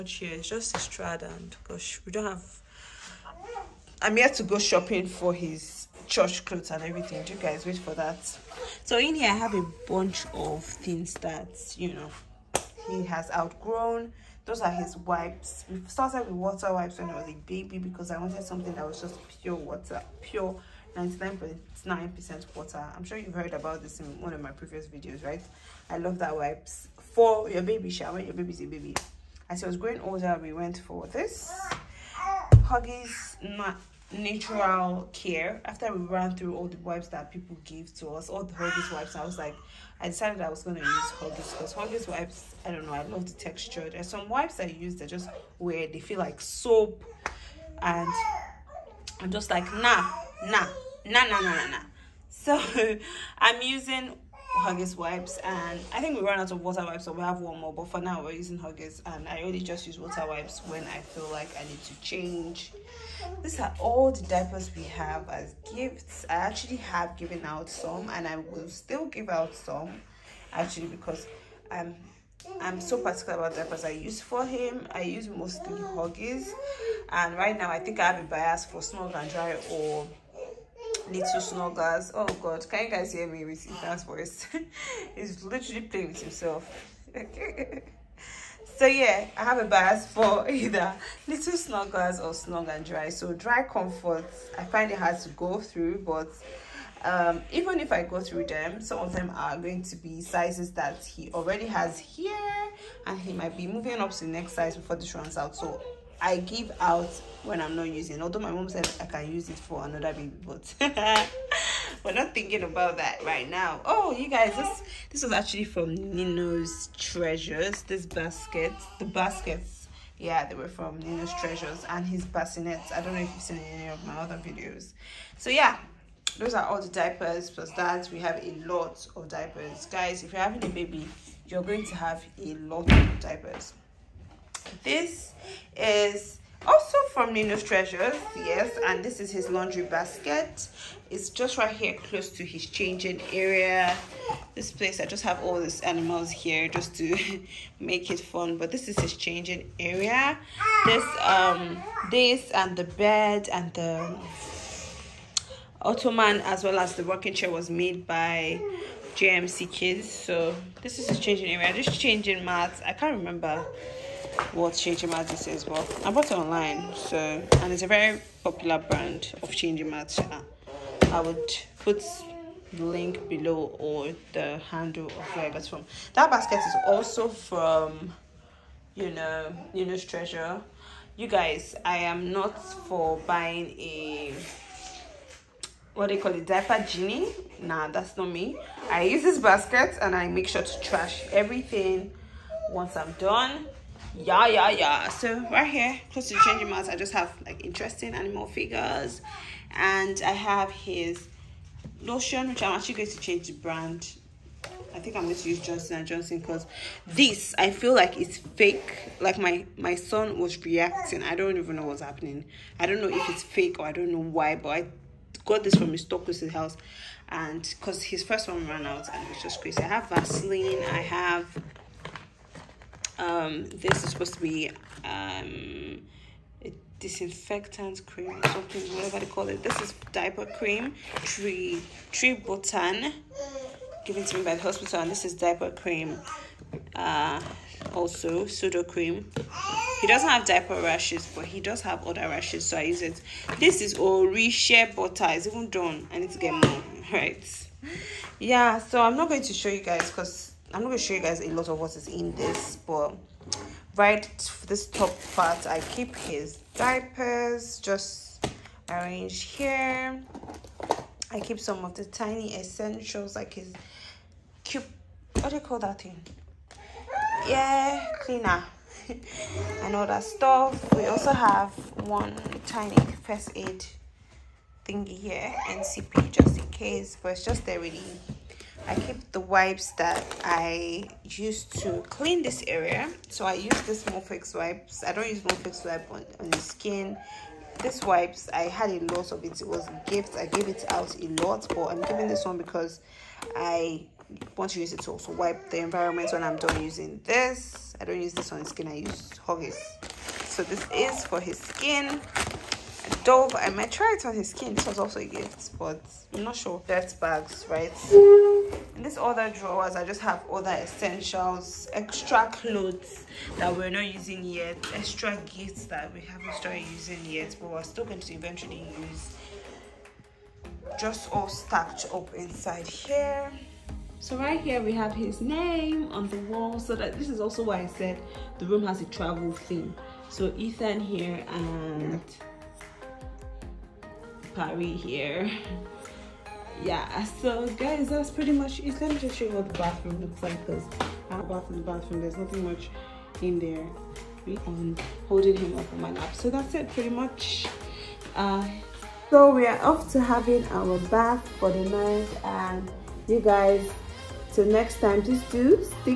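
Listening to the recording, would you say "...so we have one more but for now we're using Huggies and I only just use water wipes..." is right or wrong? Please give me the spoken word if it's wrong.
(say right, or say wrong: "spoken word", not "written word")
right.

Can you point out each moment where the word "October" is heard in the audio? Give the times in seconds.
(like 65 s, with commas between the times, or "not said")
not said.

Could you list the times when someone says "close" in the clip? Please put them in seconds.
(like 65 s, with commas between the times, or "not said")
141 s, 196 s.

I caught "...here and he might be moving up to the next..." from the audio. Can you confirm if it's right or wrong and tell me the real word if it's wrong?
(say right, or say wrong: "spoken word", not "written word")
right.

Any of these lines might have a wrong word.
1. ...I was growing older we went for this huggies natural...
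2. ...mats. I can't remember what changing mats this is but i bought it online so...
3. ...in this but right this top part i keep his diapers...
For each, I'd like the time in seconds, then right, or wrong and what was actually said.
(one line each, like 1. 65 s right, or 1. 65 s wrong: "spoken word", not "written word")
1. 29 s right
2. 162 s right
3. 252 s right.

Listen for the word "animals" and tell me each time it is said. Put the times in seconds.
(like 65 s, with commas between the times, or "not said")
145 s, 198 s.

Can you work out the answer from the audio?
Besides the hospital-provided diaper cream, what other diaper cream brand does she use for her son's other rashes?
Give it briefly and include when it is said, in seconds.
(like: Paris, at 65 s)
Sudocrem, at 238 s.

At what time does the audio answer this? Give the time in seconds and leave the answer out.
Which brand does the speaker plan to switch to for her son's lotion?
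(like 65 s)
205 s.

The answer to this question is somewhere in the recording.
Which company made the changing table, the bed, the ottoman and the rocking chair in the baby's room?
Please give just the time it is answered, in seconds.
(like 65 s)
159 s.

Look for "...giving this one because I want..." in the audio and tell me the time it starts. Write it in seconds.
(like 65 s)
291 s.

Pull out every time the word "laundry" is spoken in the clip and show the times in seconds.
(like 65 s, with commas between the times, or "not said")
139 s.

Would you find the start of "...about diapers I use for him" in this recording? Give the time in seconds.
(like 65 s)
73 s.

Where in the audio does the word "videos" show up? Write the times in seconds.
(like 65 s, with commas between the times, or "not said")
24 s, 124 s.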